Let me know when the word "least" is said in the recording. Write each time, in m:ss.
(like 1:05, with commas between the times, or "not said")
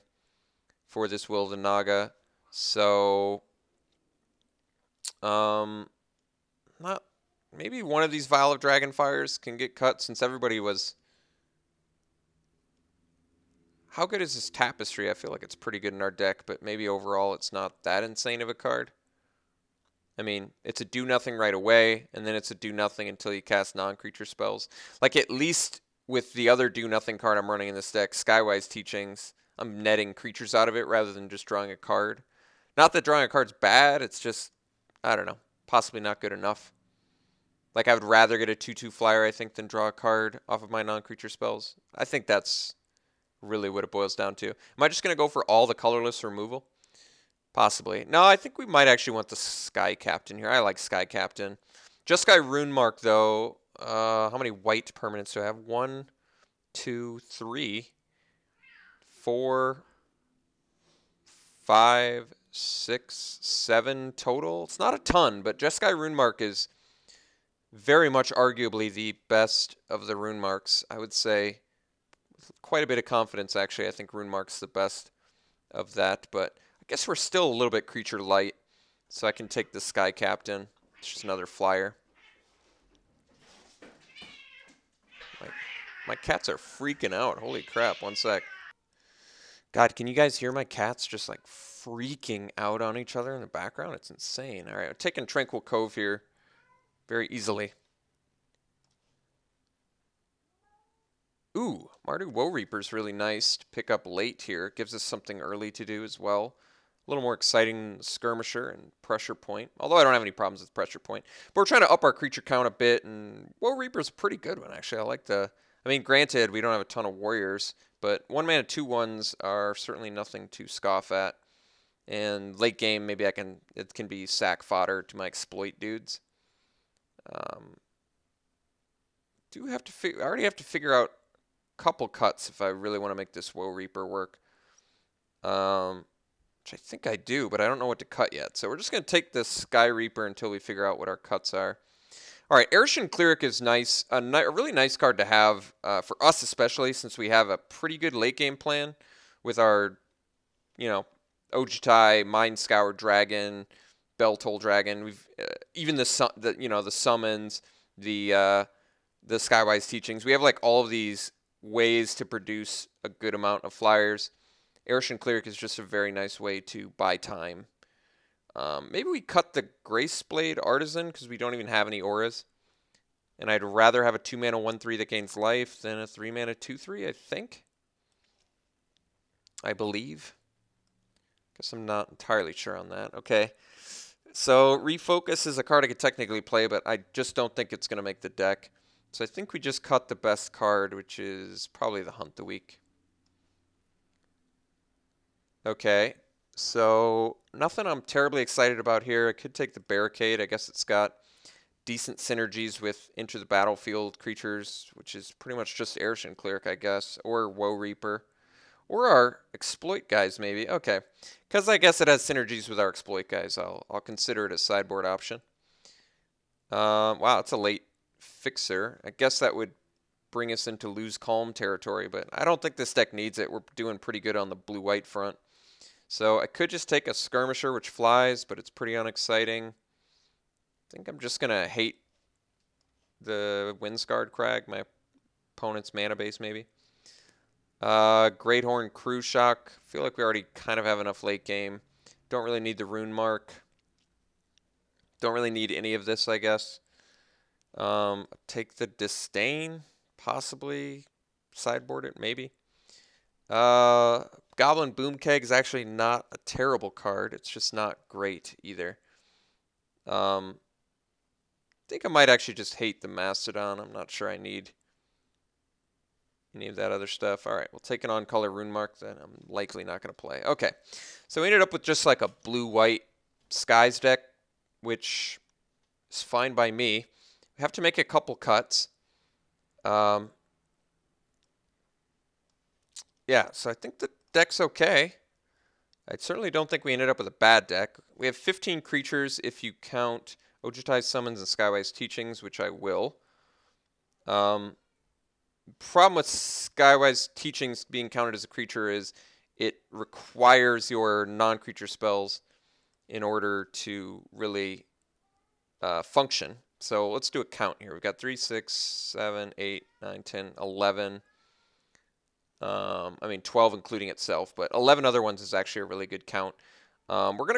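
0:25.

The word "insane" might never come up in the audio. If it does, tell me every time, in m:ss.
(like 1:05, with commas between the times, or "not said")
0:18, 1:34.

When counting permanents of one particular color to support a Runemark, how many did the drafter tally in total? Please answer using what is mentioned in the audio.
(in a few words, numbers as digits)
7.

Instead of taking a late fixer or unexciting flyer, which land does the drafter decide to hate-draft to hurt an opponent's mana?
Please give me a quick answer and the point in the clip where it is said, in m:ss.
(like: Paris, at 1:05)
Windscarred Crag, at 3:53.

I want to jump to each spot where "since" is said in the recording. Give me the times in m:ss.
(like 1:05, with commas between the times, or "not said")
0:10, 2:26.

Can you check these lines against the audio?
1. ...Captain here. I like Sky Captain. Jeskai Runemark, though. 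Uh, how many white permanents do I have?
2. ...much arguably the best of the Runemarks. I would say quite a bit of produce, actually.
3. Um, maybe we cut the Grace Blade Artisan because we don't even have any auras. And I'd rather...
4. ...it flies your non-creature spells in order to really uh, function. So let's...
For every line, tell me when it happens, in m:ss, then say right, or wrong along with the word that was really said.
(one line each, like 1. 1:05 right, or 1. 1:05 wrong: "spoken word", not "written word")
1. 0:49 right
2. 1:08 wrong: "confidence", not "produce"
3. 2:48 right
4. 4:59 wrong: "requires", not "flies".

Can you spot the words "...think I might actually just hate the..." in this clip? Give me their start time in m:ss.
4:21.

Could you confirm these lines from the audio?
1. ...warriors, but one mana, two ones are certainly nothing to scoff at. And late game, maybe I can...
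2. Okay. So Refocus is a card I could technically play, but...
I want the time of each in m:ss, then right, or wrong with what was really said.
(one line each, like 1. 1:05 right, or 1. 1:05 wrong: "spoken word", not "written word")
1. 1:57 right
2. 3:03 right.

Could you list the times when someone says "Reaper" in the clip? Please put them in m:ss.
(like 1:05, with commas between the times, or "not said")
1:42, 1:53, 2:13, 2:19, 3:27.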